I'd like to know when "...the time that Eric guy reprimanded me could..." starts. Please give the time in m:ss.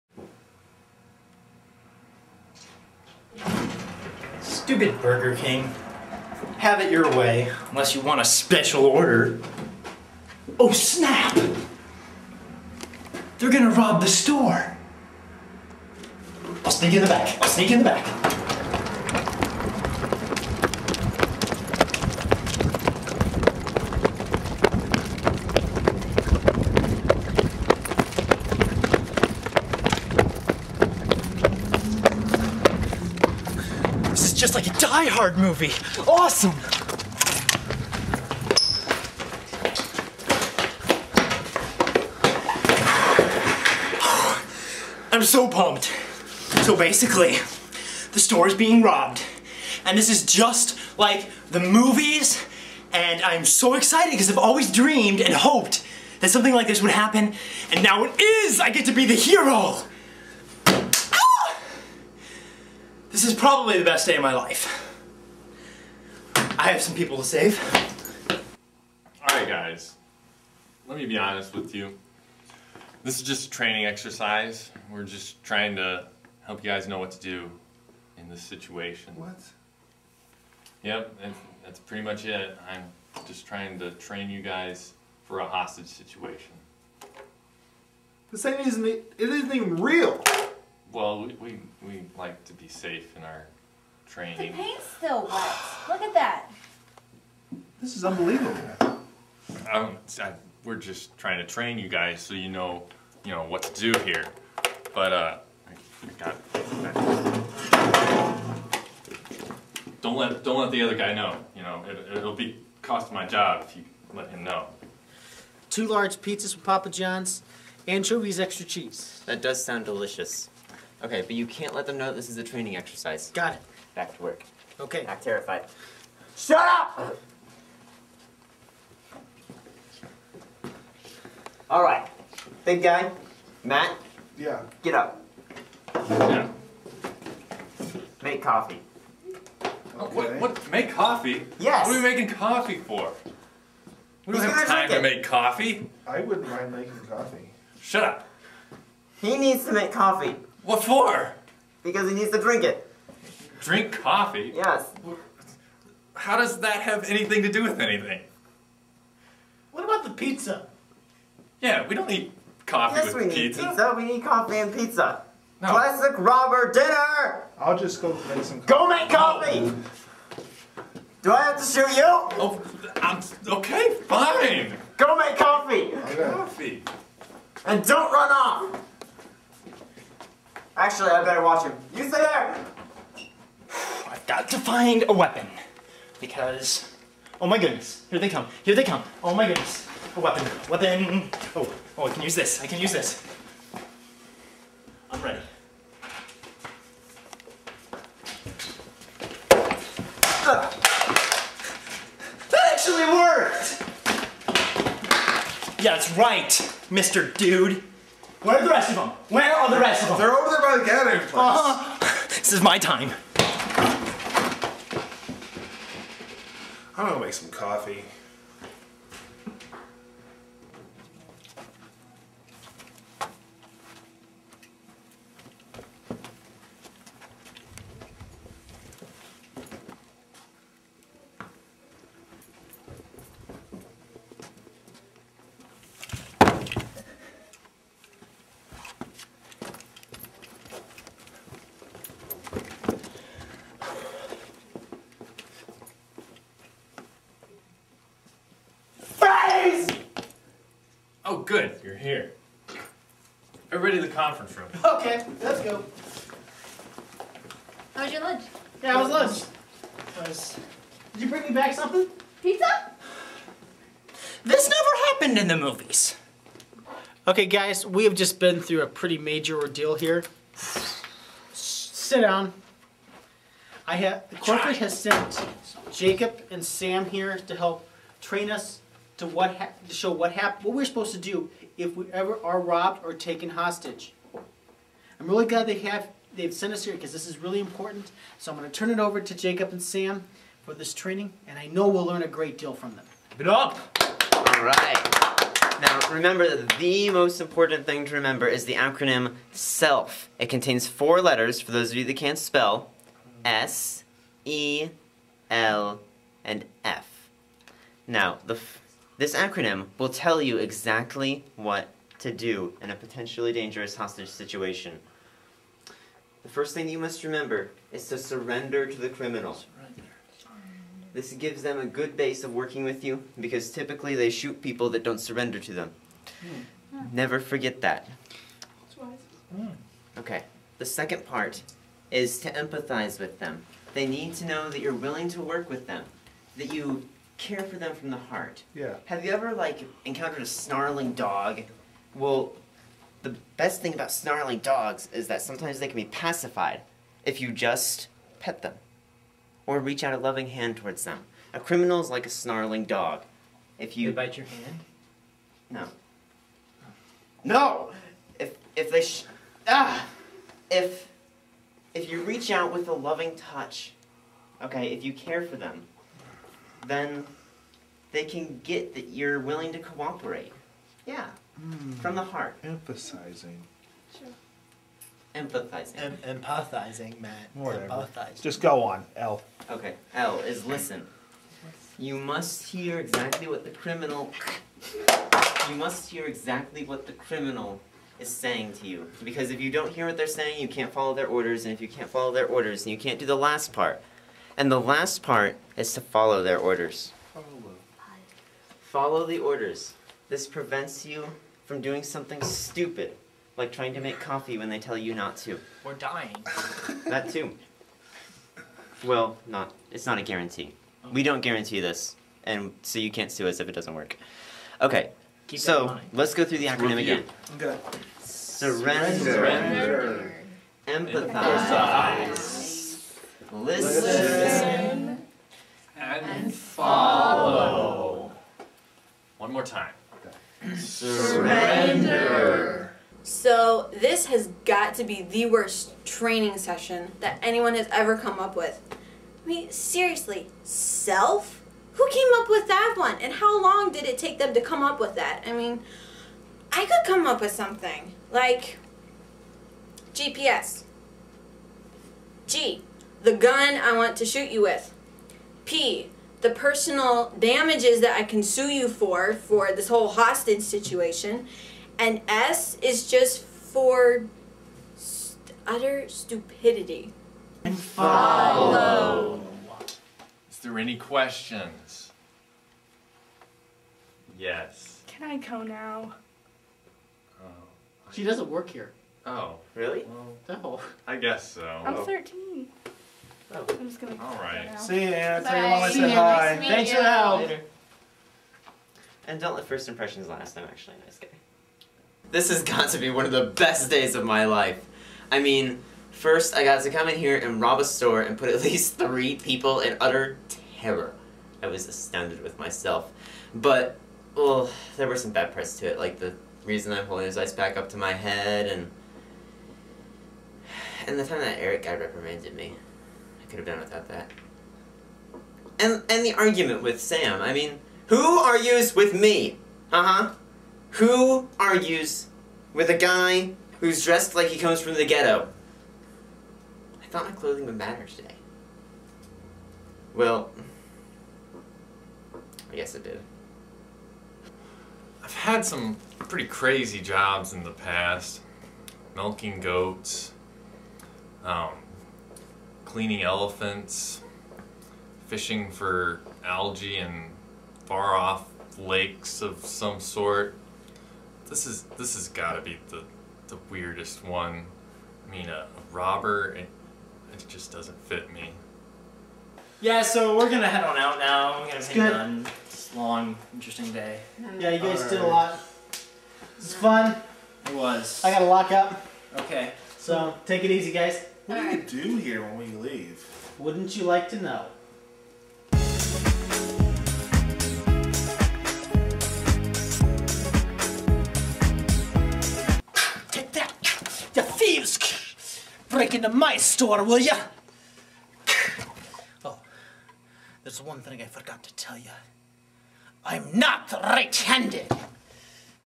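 8:31.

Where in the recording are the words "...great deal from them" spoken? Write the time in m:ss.
4:52.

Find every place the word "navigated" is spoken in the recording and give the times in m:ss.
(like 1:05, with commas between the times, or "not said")
not said.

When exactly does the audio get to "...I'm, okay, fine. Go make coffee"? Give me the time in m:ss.
2:53.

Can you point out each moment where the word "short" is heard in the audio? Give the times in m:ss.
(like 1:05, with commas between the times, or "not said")
not said.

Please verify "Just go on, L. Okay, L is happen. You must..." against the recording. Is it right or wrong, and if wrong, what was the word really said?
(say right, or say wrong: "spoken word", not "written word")
wrong: "listen", not "happen".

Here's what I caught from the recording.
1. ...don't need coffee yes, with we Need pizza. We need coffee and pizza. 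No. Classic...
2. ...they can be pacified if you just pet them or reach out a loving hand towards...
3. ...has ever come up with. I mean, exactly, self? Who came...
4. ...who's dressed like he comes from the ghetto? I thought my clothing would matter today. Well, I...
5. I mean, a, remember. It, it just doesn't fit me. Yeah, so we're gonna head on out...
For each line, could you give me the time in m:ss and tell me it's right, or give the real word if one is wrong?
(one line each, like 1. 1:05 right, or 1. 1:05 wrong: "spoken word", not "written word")
1. 2:41 right
2. 5:45 right
3. 7:17 wrong: "seriously", not "exactly"
4. 8:43 right
5. 9:15 wrong: "robber", not "remember".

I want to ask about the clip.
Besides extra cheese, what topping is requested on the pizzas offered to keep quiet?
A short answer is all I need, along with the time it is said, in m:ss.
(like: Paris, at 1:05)
anchovies, at 1:57.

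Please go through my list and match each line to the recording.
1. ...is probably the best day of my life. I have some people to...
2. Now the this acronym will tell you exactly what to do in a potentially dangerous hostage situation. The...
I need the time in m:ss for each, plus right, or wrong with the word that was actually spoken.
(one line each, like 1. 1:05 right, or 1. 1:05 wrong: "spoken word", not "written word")
1. 1:03 right
2. 5:08 right.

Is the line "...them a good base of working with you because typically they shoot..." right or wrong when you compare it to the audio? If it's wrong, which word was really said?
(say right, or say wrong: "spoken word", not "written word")
right.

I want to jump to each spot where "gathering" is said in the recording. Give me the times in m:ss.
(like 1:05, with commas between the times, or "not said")
3:30.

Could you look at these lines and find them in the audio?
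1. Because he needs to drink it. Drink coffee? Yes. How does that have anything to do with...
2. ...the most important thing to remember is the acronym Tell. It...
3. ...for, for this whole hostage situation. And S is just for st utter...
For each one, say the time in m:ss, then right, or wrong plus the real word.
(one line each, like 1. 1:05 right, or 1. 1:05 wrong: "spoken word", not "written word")
1. 2:31 right
2. 4:56 wrong: "SELF", not "Tell"
3. 7:38 right.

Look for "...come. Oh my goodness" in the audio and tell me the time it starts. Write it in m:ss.
3:08.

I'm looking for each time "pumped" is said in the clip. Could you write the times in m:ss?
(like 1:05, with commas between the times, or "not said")
0:45.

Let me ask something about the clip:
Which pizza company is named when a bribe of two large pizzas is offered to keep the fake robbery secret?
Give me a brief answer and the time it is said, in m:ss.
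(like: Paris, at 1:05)
Papa John's, at 1:56.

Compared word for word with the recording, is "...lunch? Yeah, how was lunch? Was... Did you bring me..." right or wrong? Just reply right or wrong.
right.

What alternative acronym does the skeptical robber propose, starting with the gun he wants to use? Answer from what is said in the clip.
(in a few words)
GPS.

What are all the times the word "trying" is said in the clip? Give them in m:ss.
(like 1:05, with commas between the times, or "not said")
1:15, 1:23, 1:41, 6:43.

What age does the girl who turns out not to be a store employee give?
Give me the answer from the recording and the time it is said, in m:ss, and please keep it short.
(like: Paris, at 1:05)
13, at 8:02.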